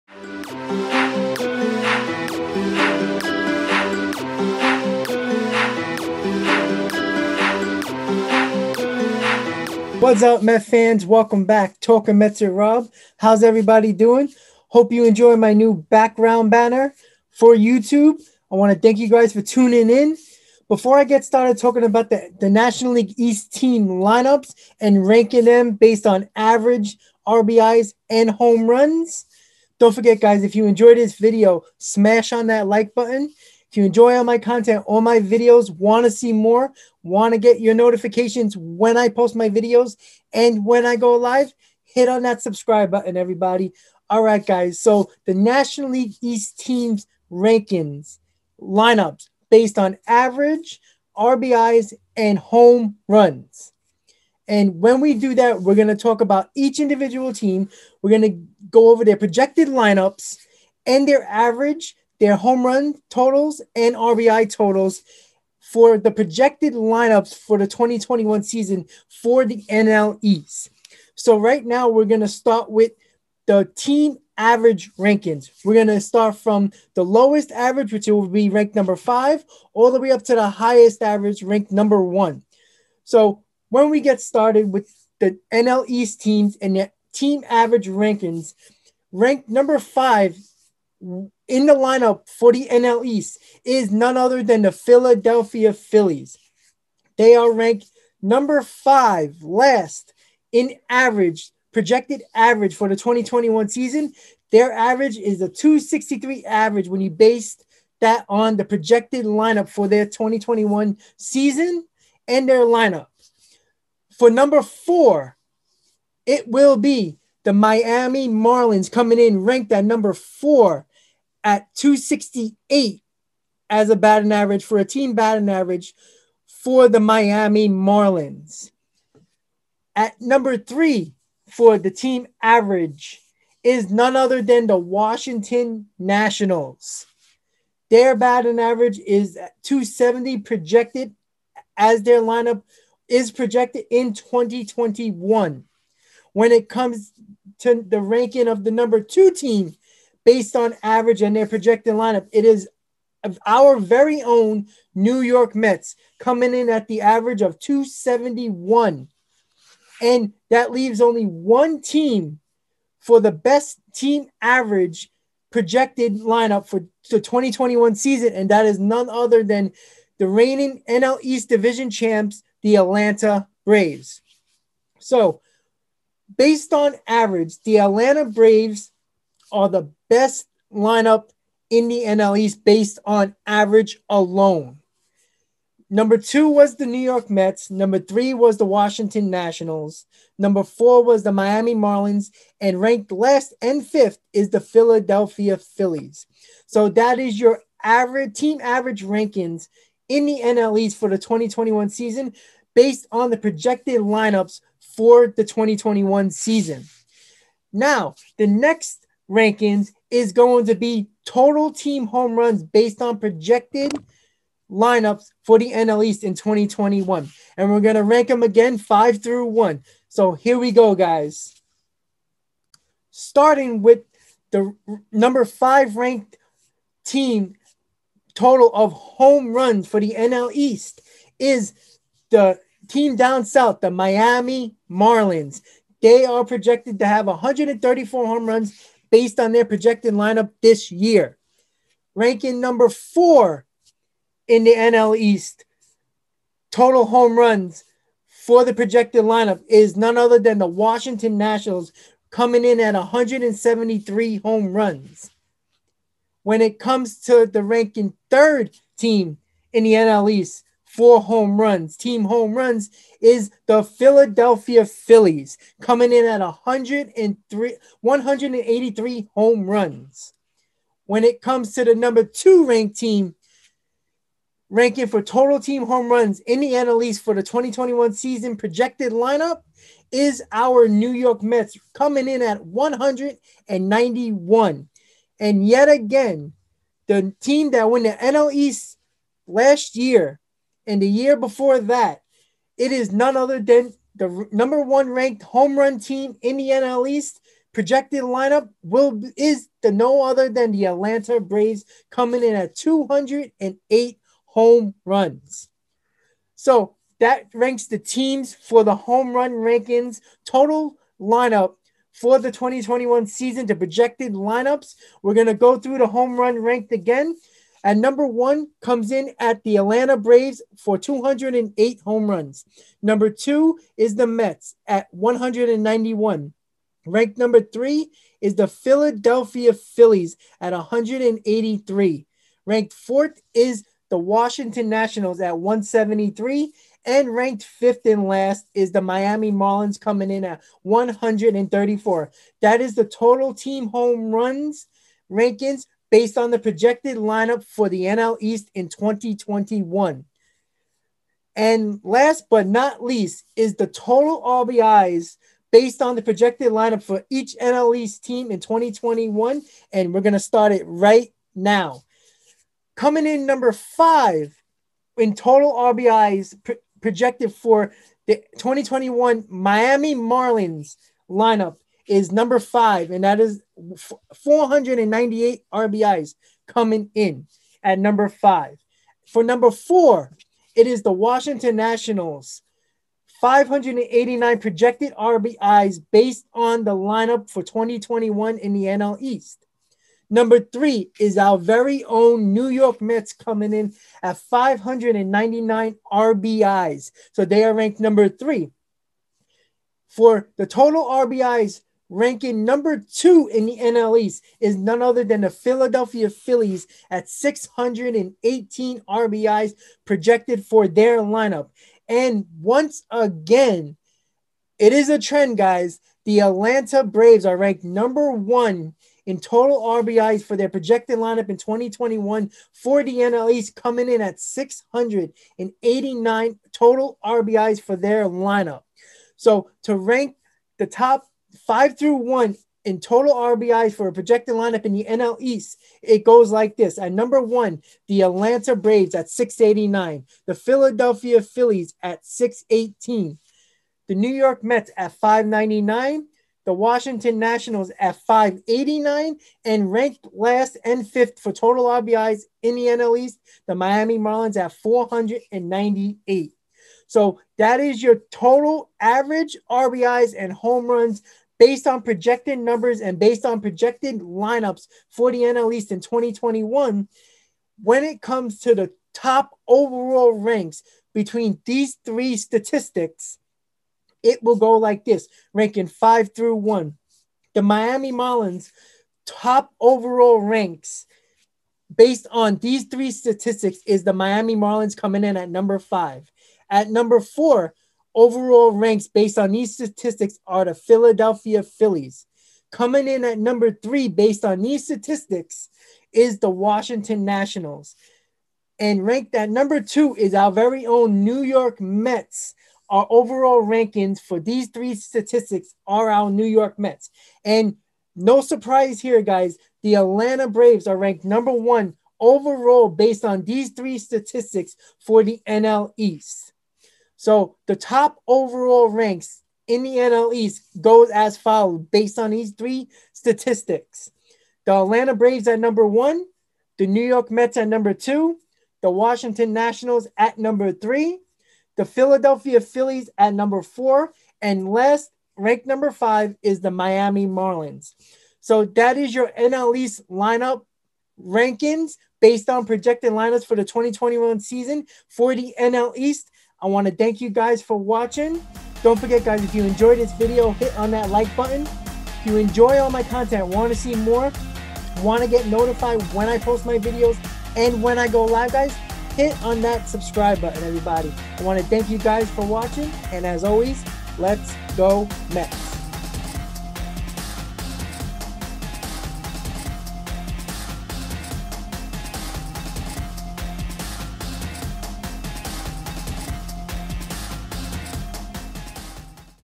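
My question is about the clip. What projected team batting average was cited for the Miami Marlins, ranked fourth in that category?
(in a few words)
.268.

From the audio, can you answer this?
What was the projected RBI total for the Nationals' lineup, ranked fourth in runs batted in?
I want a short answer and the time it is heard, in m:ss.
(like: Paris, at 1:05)
589, at 6:23.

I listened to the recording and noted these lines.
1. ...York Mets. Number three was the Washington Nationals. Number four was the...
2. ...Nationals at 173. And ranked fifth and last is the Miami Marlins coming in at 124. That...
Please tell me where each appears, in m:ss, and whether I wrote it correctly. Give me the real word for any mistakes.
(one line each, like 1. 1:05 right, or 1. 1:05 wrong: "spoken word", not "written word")
1. 3:06 right
2. 5:34 wrong: "134", not "124".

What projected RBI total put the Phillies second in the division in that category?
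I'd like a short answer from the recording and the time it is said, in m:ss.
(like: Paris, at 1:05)
618, at 6:47.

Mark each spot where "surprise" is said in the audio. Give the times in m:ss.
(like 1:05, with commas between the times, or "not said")
8:28.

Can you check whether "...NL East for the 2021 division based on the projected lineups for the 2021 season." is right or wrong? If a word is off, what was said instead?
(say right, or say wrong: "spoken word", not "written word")
wrong: "season", not "division".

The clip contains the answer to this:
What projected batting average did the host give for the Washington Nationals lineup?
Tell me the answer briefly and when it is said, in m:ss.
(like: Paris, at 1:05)
.270, at 2:19.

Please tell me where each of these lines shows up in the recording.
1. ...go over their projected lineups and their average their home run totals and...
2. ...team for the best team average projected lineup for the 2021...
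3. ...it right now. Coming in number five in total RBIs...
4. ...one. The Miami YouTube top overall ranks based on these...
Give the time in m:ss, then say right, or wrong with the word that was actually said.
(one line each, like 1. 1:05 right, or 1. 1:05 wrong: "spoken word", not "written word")
1. 0:58 right
2. 2:41 right
3. 6:00 right
4. 7:56 wrong: "Marlins", not "YouTube".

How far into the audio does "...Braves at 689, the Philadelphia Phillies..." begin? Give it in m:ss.
7:18.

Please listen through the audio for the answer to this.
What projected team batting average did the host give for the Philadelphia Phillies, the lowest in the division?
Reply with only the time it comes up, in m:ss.
1:45.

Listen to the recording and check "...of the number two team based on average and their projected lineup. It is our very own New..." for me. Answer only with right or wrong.
right.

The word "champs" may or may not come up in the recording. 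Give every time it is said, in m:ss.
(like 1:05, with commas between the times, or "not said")
2:51.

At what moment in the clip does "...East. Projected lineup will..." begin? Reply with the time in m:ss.
4:57.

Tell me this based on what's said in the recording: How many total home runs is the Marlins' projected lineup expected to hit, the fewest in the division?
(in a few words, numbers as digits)
134.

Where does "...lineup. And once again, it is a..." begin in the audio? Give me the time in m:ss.
6:51.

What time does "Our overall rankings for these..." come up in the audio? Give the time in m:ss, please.
8:22.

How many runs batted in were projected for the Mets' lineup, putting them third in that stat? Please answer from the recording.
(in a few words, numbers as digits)
599.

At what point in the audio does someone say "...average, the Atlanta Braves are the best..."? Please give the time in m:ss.
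2:57.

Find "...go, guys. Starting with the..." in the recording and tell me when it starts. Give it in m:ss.
3:40.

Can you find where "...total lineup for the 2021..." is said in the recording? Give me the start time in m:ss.
5:10.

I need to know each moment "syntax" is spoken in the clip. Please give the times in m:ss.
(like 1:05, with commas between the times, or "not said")
not said.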